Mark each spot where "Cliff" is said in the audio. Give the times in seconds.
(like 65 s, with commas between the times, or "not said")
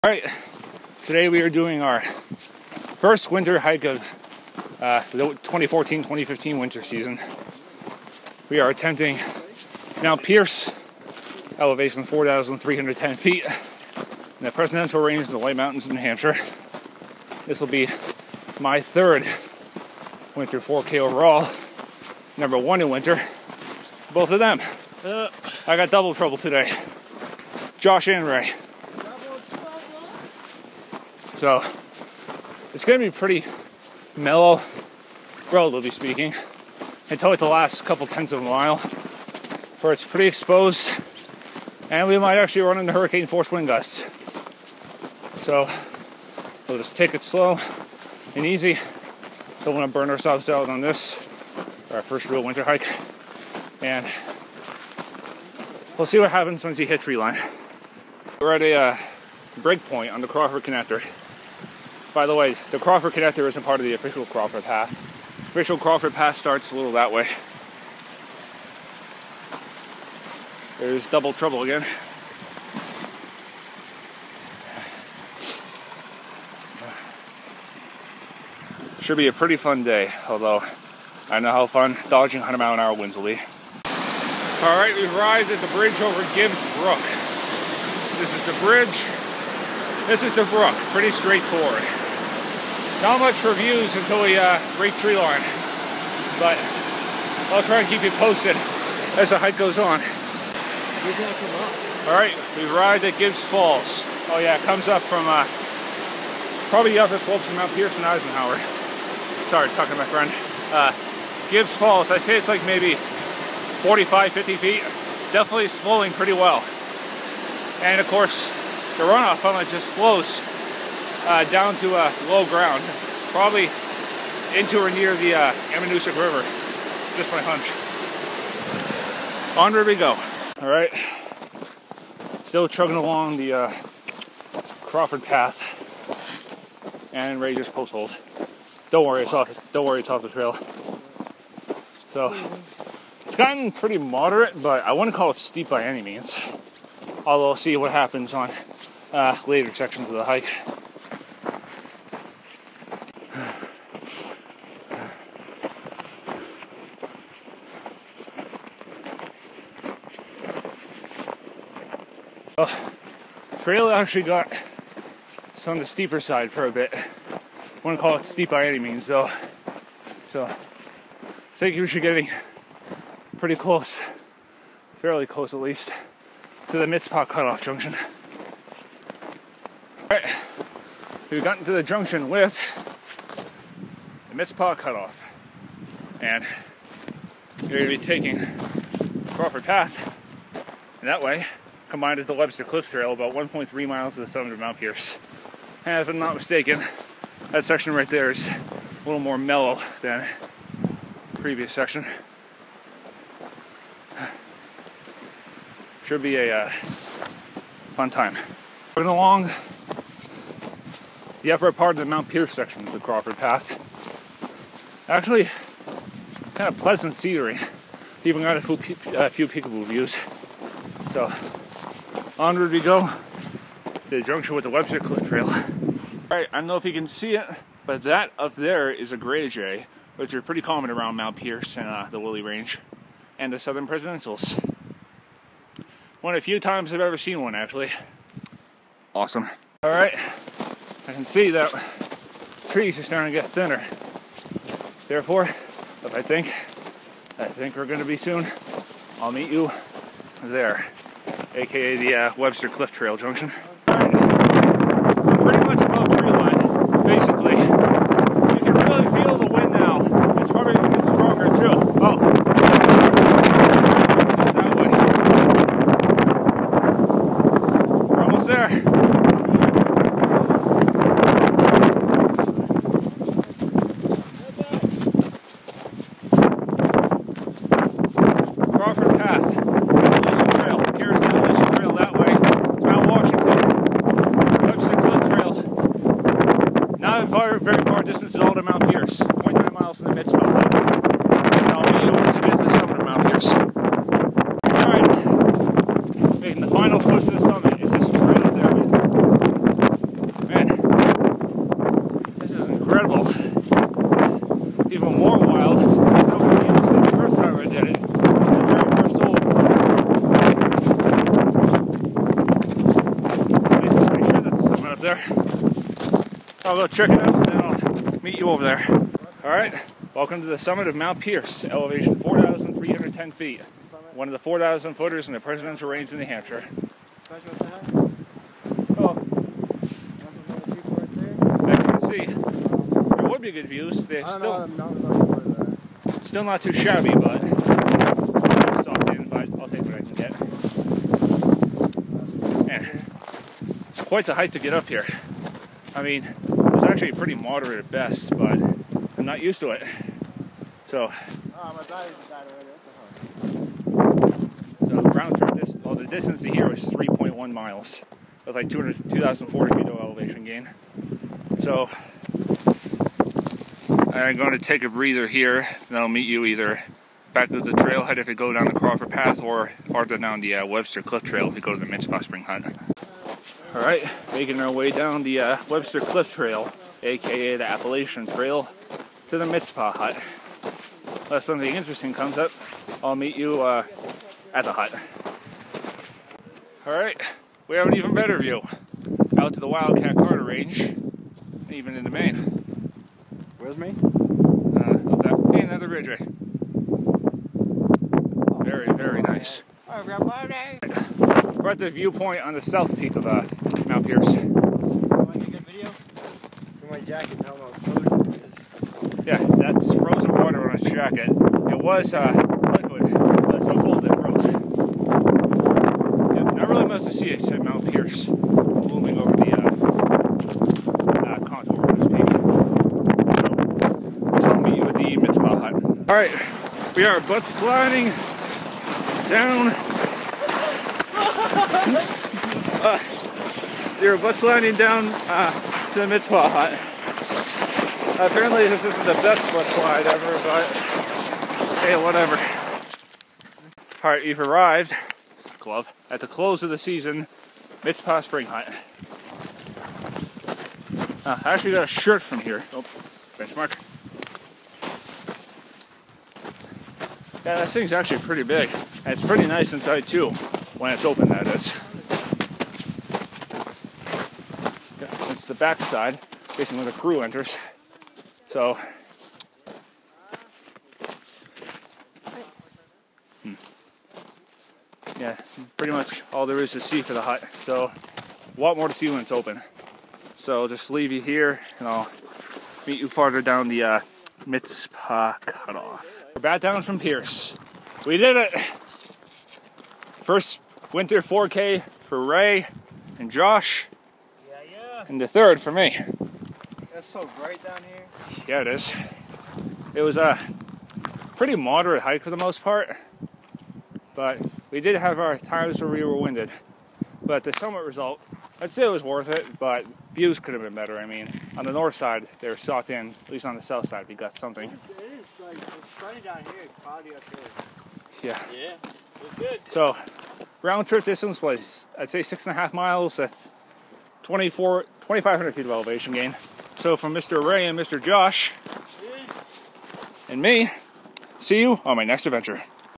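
192 s, 224 s, 252 s, 371 s, 376 s.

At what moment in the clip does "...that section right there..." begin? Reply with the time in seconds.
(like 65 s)
197 s.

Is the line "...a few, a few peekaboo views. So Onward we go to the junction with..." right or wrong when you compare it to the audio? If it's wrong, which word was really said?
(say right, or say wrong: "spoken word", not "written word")
right.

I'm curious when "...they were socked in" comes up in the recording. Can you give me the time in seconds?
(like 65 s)
512 s.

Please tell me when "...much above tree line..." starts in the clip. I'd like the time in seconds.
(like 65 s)
255 s.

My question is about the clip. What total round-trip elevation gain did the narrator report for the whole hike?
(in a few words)
2,500 feet.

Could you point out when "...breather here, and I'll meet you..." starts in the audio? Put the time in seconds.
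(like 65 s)
364 s.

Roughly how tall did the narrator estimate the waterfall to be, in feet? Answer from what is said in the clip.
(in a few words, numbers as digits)
45 to 50 feet.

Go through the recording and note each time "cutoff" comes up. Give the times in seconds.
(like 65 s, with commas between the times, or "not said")
177 s, 184 s, 485 s.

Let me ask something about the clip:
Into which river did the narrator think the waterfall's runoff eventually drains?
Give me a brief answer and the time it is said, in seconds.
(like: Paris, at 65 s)
Ammonoosuc River, at 125 s.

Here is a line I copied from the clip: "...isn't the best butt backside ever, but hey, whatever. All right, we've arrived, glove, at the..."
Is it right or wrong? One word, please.
wrong.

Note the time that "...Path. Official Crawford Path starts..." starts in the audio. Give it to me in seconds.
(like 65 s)
64 s.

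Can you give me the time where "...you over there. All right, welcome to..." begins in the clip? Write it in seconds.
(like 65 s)
318 s.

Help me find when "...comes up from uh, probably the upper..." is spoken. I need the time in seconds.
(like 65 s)
104 s.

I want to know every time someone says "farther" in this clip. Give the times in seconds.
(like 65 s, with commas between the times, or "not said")
369 s, 483 s.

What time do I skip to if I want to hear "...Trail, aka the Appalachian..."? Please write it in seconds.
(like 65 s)
376 s.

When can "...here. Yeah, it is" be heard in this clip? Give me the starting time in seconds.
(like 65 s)
497 s.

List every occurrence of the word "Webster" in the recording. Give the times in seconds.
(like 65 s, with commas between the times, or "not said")
192 s, 224 s, 252 s, 370 s, 375 s.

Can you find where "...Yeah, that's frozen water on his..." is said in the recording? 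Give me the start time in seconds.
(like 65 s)
409 s.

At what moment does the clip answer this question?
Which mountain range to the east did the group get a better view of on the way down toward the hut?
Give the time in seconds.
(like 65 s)
389 s.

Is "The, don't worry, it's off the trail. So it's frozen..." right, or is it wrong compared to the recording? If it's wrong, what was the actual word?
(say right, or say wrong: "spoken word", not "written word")
wrong: "gotten", not "frozen".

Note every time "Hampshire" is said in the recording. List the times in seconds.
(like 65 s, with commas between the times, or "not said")
15 s, 326 s.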